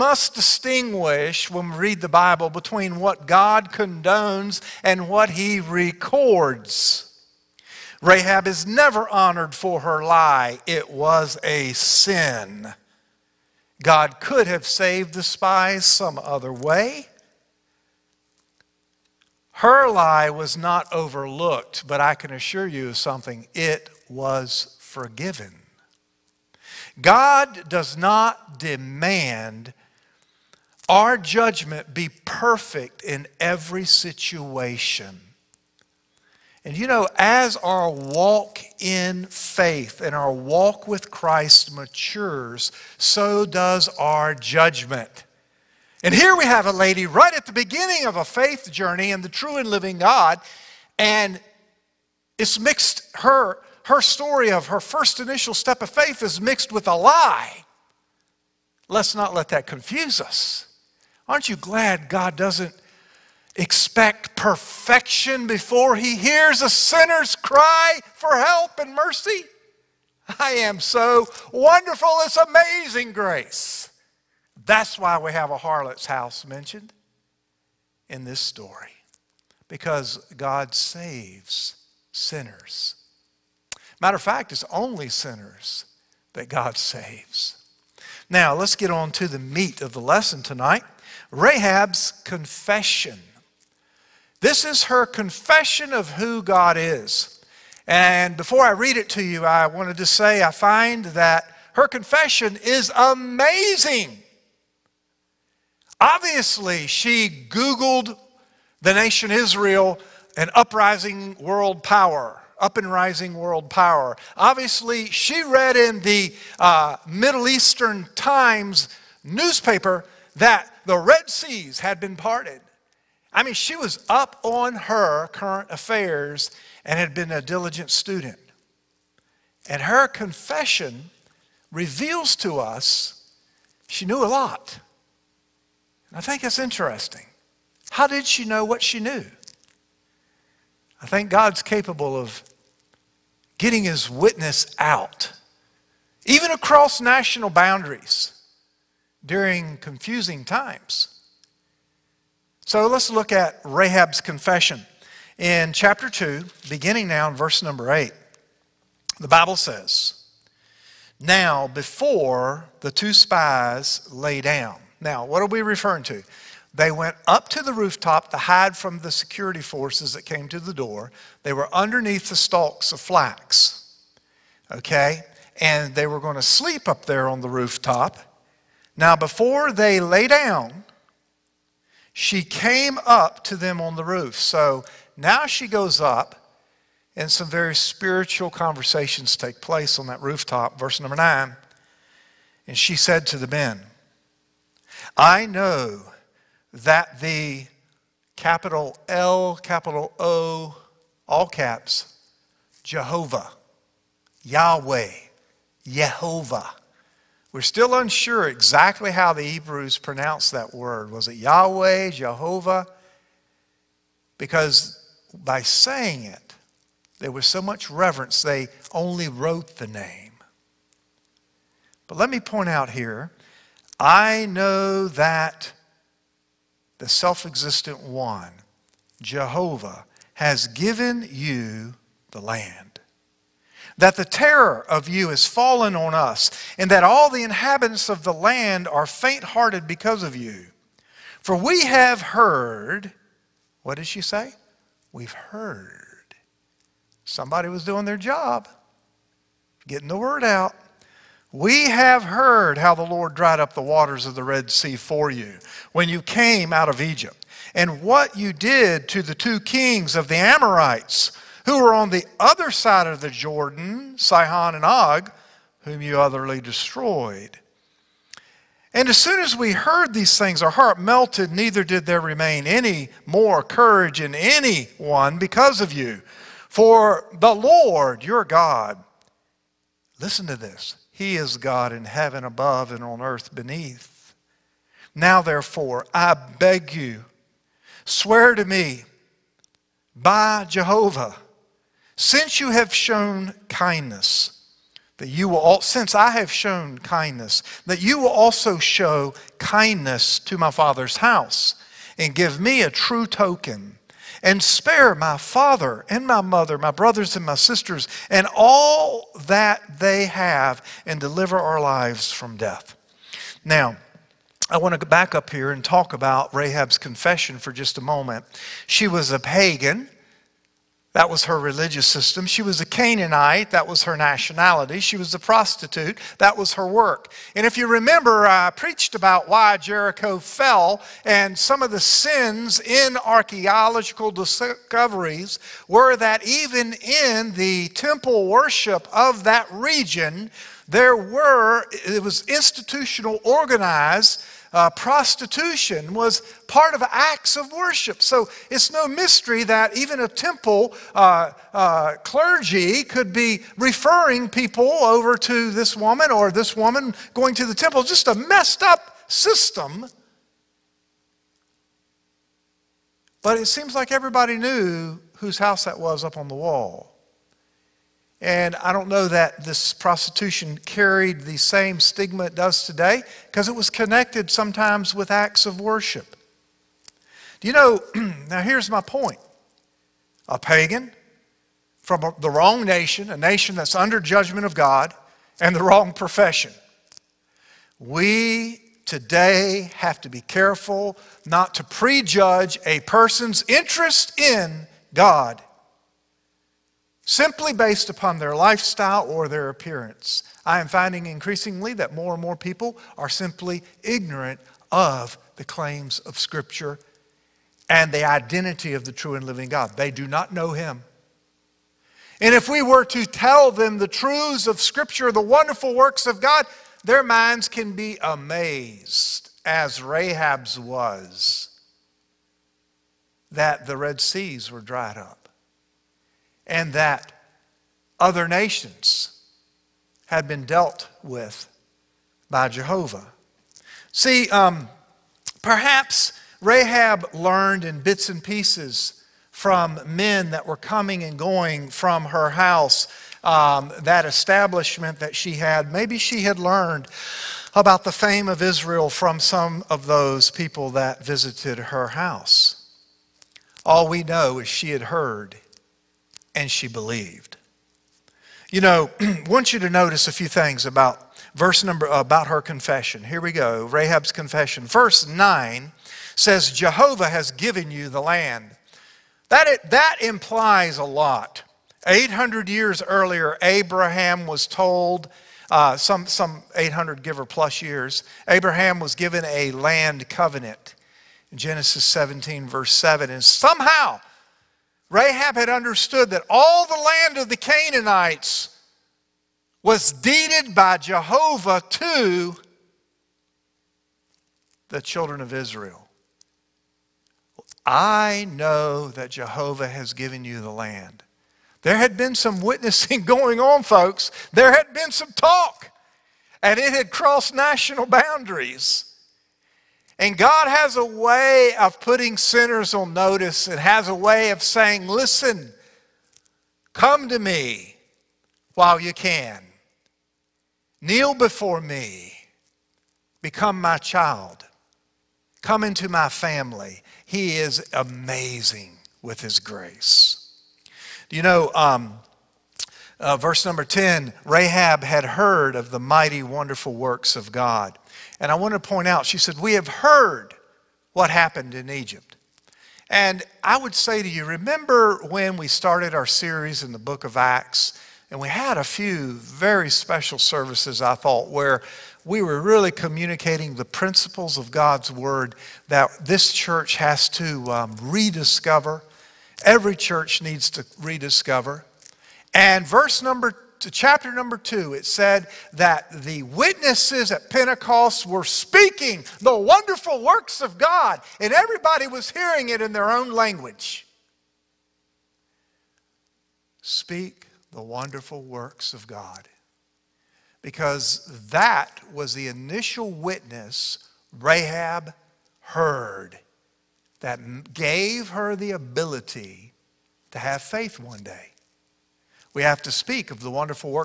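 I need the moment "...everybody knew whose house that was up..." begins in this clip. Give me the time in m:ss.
6:04.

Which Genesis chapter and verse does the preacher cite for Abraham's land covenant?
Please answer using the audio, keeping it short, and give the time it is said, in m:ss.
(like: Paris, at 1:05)
Genesis 17:7, at 8:01.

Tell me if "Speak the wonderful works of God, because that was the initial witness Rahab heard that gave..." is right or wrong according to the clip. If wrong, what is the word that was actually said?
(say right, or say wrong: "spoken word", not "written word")
right.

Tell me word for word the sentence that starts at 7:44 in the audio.
Verse 9 says Jehovah has given you the land.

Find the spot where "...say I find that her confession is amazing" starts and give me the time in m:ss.
1:40.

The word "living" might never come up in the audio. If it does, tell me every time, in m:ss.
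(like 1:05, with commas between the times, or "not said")
0:49, 6:49.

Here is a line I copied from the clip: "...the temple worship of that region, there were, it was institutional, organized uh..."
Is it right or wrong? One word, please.
right.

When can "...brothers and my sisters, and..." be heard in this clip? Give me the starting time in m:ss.
5:06.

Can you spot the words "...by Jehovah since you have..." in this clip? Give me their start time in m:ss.
4:50.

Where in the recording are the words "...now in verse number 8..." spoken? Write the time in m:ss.
2:37.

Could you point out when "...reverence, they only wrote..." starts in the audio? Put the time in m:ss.
3:37.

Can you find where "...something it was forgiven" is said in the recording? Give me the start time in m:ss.
0:22.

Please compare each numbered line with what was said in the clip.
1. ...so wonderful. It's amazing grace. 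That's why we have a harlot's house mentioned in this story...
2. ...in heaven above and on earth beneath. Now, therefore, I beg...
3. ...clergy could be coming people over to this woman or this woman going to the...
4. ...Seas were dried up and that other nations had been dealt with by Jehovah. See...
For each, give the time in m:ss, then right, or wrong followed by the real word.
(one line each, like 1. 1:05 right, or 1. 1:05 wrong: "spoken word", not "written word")
1. 1:10 right
2. 4:41 right
3. 5:52 wrong: "referring", not "coming"
4. 7:04 right.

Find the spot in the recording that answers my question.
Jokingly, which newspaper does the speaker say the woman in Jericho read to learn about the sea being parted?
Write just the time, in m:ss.
1:57.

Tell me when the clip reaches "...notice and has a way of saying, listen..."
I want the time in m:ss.
8:33.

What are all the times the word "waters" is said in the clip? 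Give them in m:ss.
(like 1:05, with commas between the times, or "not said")
4:13.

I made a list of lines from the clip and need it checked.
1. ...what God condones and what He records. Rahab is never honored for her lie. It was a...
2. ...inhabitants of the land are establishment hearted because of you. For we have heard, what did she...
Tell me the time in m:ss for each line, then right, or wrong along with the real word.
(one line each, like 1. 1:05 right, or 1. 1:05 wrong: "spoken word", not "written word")
1. 0:03 right
2. 3:57 wrong: "faint", not "establishment".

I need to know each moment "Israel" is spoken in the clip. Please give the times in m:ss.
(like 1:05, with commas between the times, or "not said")
1:49, 7:28, 8:15.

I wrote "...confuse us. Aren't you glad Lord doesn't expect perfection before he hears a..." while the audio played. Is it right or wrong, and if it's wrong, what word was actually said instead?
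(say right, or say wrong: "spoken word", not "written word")
wrong: "God", not "Lord".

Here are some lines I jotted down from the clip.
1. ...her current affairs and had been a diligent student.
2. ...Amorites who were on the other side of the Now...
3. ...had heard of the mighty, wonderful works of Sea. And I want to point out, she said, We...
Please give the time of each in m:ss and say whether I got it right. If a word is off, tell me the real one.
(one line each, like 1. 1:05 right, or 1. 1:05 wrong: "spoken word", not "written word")
1. 2:04 right
2. 4:20 wrong: "Jordan", not "Now"
3. 8:55 wrong: "God", not "Sea".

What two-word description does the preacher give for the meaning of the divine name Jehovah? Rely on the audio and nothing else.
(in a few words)
Self existent one.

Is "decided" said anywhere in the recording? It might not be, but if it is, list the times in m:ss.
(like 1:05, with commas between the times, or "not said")
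not said.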